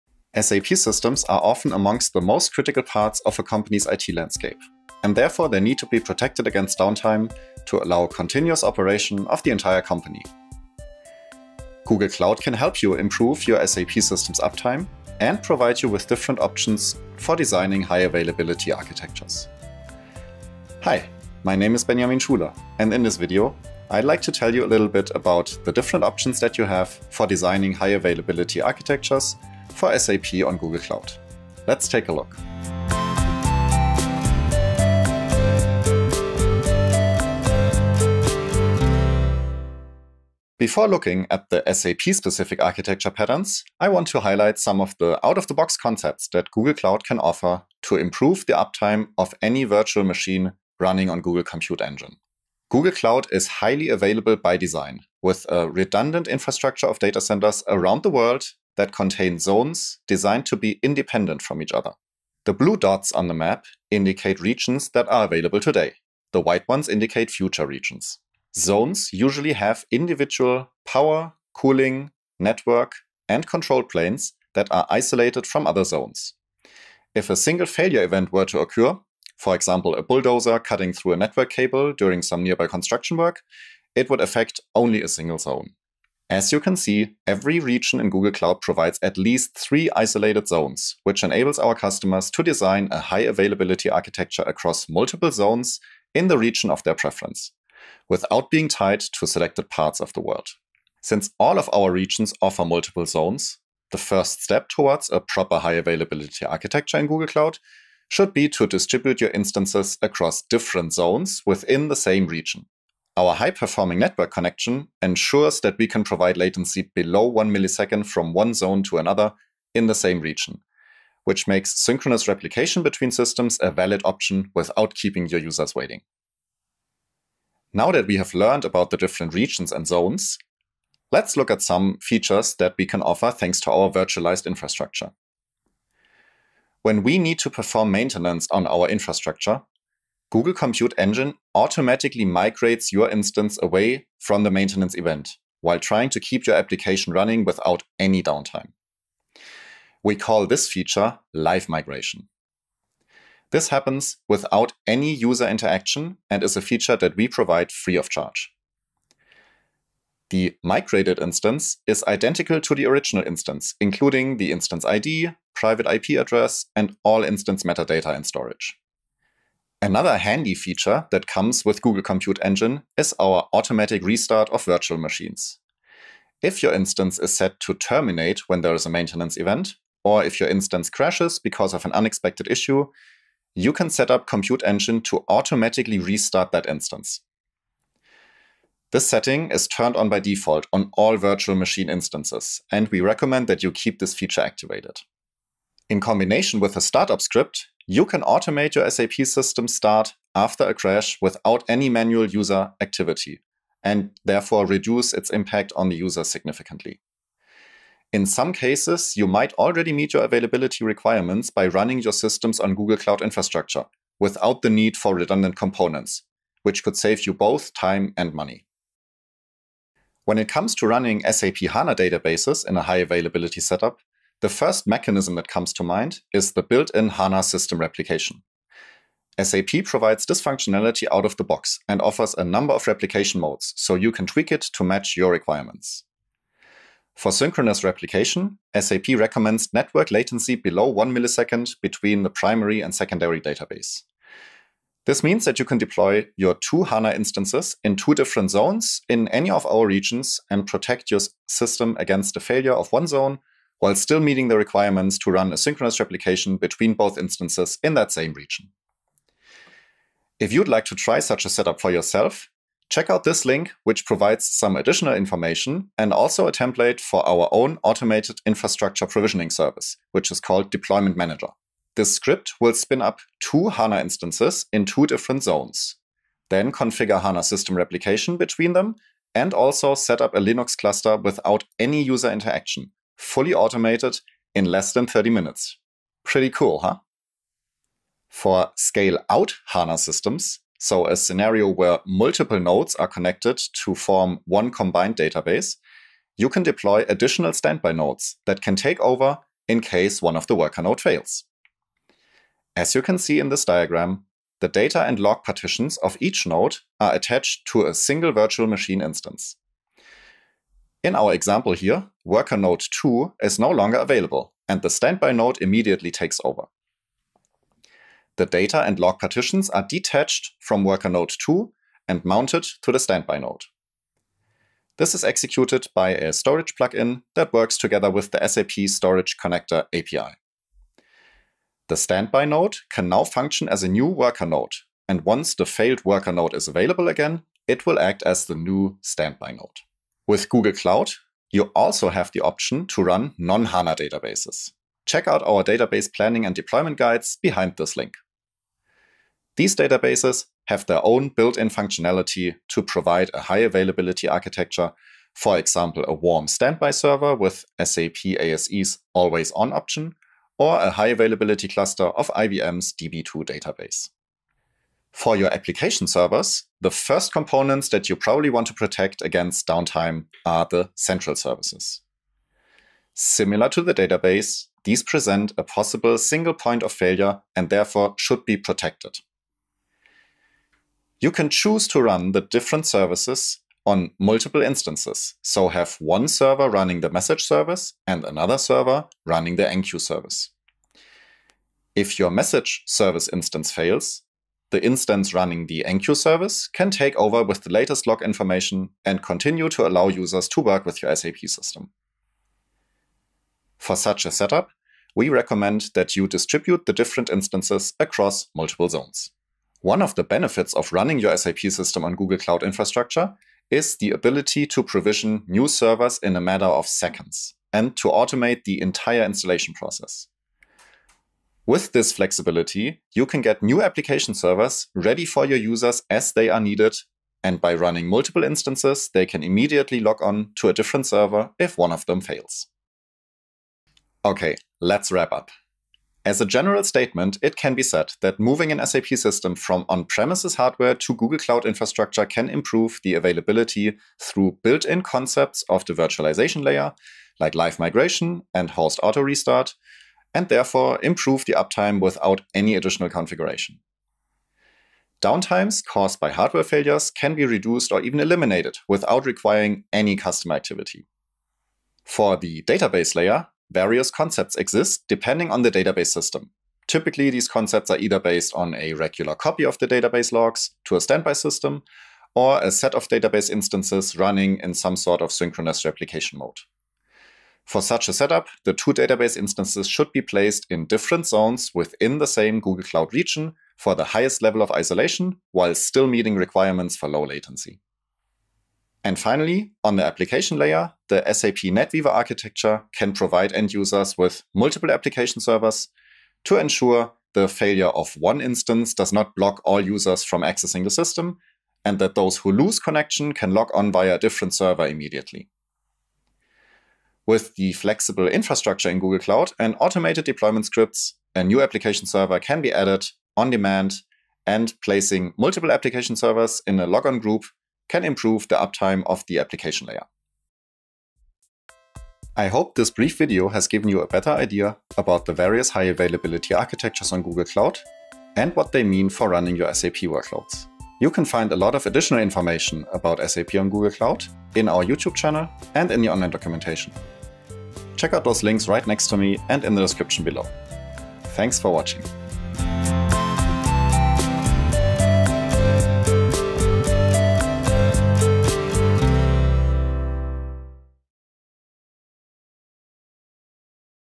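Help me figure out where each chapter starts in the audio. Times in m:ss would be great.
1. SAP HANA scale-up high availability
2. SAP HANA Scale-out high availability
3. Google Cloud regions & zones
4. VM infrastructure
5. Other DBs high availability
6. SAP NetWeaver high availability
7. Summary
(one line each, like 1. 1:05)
1. 3:40
2. 4:48
3. 0:40
4. 2:08
5. 5:40
6. 6:05
7. 7:13.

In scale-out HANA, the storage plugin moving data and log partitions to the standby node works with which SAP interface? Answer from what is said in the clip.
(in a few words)
SAP Storage Connector API.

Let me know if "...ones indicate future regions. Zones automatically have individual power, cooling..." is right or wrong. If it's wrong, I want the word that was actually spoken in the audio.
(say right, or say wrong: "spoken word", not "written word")
wrong: "usually", not "automatically".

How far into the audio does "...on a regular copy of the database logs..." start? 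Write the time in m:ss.
7:48.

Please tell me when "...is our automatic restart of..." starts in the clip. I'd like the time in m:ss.
2:52.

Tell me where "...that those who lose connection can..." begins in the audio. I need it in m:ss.
8:21.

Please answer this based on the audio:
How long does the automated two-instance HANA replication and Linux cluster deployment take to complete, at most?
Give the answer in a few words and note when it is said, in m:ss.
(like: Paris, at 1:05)
under 30 minutes, at 4:44.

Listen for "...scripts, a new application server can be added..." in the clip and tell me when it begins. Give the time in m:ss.
8:30.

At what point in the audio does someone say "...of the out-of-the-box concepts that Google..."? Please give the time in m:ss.
0:44.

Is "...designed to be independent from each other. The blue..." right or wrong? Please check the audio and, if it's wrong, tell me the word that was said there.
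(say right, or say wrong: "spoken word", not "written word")
right.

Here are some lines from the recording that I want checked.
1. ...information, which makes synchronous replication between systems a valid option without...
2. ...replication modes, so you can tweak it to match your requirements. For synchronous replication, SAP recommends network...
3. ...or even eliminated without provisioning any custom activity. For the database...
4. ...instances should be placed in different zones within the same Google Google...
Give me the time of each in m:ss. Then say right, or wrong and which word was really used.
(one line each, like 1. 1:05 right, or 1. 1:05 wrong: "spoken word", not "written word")
1. 2:00 wrong: "region", not "information"
2. 3:52 right
3. 7:37 wrong: "requiring", not "provisioning"
4. 7:59 wrong: "Cloud", not "Google".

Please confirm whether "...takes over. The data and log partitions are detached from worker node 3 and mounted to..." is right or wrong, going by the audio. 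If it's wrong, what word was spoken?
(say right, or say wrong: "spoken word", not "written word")
wrong: "2", not "3".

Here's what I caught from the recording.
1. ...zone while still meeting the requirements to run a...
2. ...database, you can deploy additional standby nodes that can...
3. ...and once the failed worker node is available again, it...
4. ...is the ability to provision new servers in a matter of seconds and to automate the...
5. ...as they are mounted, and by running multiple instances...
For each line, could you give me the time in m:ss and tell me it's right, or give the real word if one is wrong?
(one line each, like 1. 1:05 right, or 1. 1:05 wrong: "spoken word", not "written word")
1. 4:13 right
2. 4:55 right
3. 5:35 right
4. 6:53 right
5. 7:06 wrong: "needed", not "mounted".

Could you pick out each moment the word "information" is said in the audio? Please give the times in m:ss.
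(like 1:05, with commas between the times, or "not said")
4:25, 6:38, 8:52.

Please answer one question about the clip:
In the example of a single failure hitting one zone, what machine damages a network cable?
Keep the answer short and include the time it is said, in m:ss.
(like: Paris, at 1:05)
bulldozer, at 1:20.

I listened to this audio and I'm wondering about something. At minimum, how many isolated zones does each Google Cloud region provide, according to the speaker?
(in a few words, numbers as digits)
3.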